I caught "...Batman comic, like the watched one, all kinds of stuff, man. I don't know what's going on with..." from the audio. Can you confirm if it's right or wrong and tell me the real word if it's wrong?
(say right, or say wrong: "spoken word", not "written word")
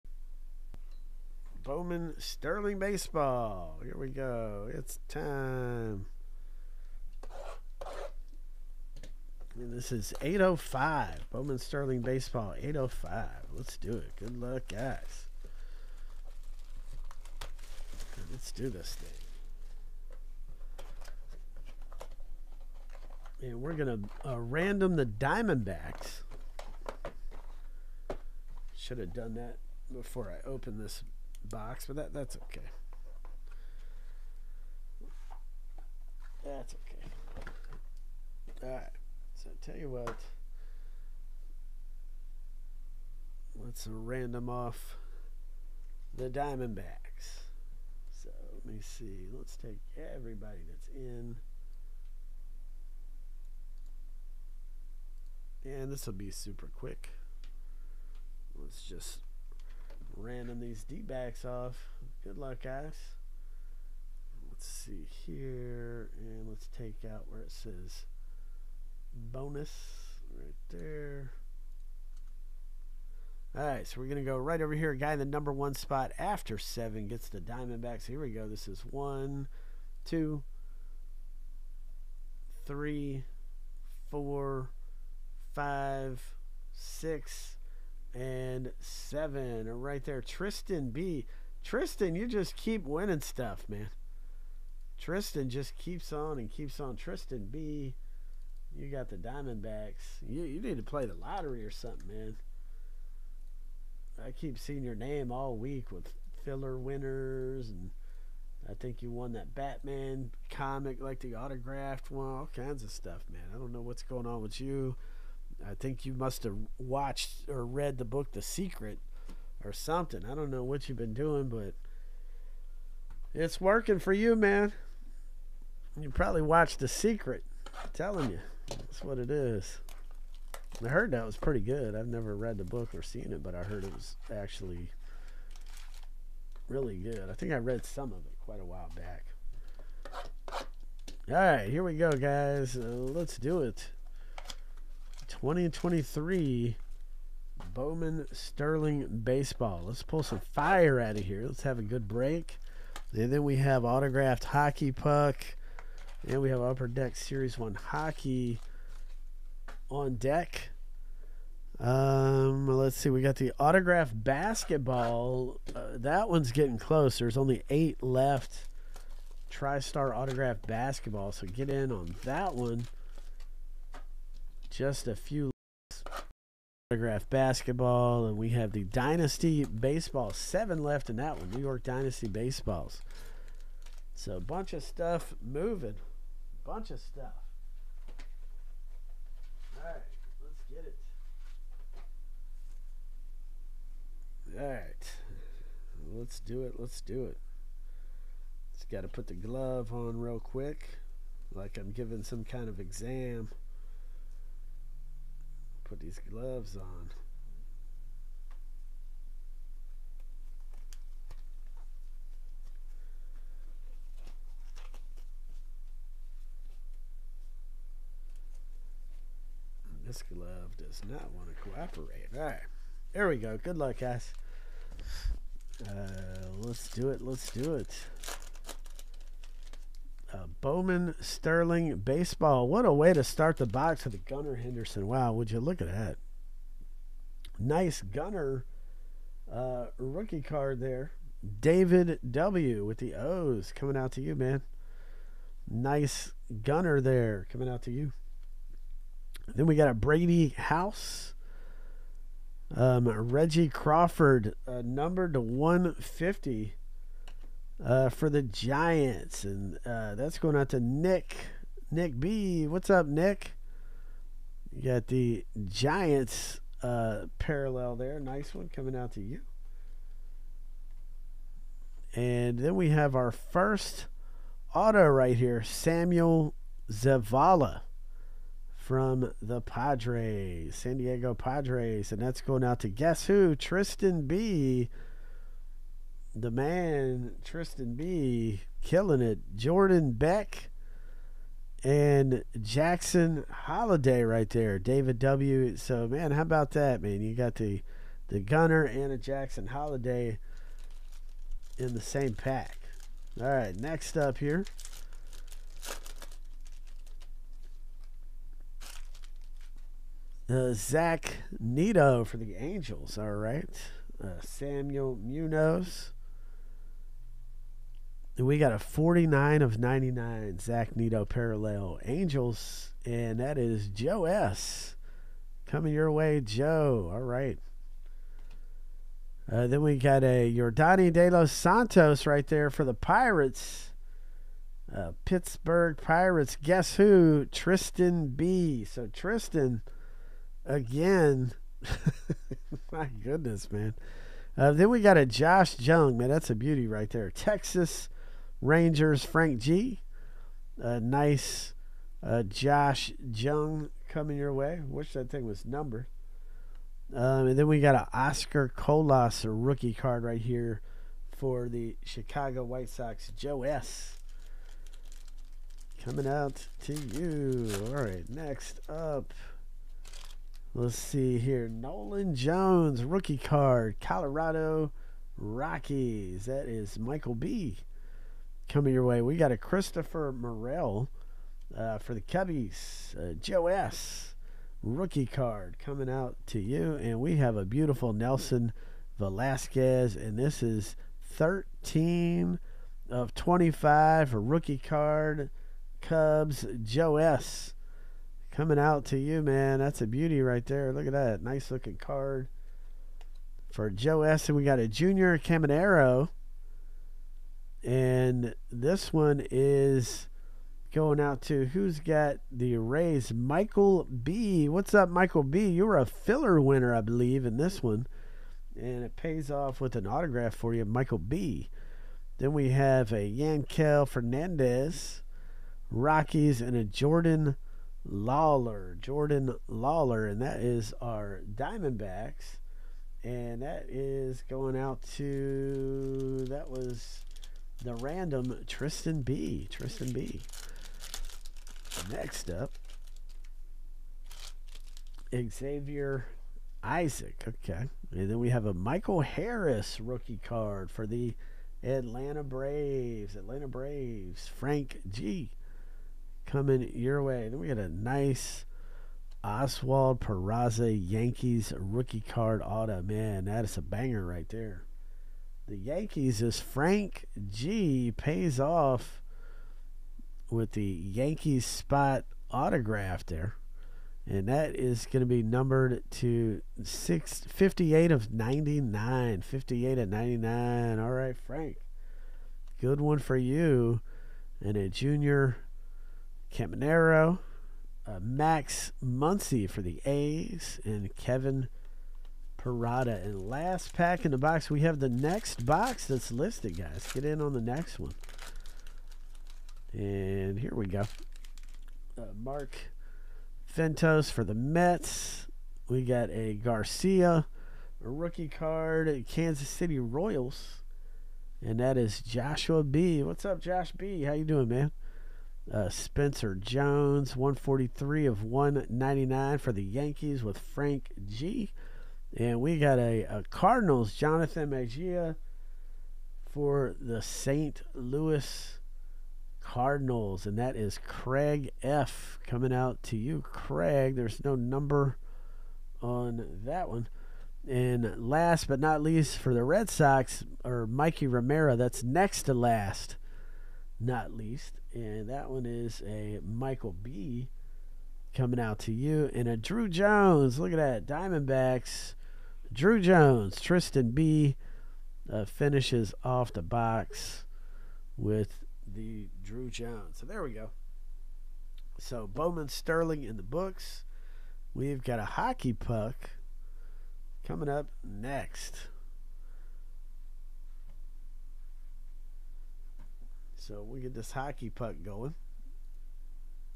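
wrong: "autographed", not "watched".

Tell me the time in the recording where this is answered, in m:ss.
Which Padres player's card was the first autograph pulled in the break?
4:35.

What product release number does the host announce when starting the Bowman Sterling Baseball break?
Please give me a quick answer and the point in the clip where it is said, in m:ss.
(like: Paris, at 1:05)
805, at 0:09.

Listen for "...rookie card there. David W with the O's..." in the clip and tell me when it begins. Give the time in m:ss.
3:59.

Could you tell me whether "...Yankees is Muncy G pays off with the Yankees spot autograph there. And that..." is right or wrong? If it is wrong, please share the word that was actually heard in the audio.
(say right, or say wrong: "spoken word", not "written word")
wrong: "Frank", not "Muncy".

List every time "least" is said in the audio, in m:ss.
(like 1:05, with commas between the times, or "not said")
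8:59, 9:04.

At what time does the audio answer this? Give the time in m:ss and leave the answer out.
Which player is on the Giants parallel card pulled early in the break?
4:13.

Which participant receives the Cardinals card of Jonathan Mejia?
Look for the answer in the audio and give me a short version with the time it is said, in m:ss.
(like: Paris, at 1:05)
Craig F., at 8:51.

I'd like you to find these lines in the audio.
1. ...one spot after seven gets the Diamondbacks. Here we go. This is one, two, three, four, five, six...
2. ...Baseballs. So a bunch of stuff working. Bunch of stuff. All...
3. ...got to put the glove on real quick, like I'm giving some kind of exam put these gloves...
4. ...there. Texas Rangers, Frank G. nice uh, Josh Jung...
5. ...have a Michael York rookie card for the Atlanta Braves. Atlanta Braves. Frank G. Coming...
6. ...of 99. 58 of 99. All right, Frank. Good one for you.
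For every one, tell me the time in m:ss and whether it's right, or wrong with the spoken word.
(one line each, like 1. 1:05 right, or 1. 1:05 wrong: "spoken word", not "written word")
1. 1:15 right
2. 3:02 wrong: "moving", not "working"
3. 3:18 right
4. 5:47 right
5. 7:28 wrong: "Harris", not "York"
6. 7:58 right.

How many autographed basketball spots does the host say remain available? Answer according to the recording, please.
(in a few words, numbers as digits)
8.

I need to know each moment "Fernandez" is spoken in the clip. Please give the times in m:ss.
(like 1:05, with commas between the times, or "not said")
7:04.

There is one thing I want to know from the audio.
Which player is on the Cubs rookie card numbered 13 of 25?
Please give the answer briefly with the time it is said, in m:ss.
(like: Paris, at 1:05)
Nelson Velazquez, at 6:28.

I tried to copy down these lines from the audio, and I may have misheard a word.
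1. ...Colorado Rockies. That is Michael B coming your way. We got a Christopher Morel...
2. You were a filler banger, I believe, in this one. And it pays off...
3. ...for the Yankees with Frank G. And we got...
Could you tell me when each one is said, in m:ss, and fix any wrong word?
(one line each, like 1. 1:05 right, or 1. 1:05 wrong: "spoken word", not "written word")
1. 6:13 right
2. 6:55 wrong: "winner", not "banger"
3. 8:39 right.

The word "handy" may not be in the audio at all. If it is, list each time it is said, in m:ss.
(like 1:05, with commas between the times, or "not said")
not said.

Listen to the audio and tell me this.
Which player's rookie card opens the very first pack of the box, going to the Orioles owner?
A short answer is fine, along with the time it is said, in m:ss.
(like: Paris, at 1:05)
Gunnar Henderson, at 3:54.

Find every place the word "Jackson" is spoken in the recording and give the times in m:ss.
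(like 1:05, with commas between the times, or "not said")
4:52, 4:59.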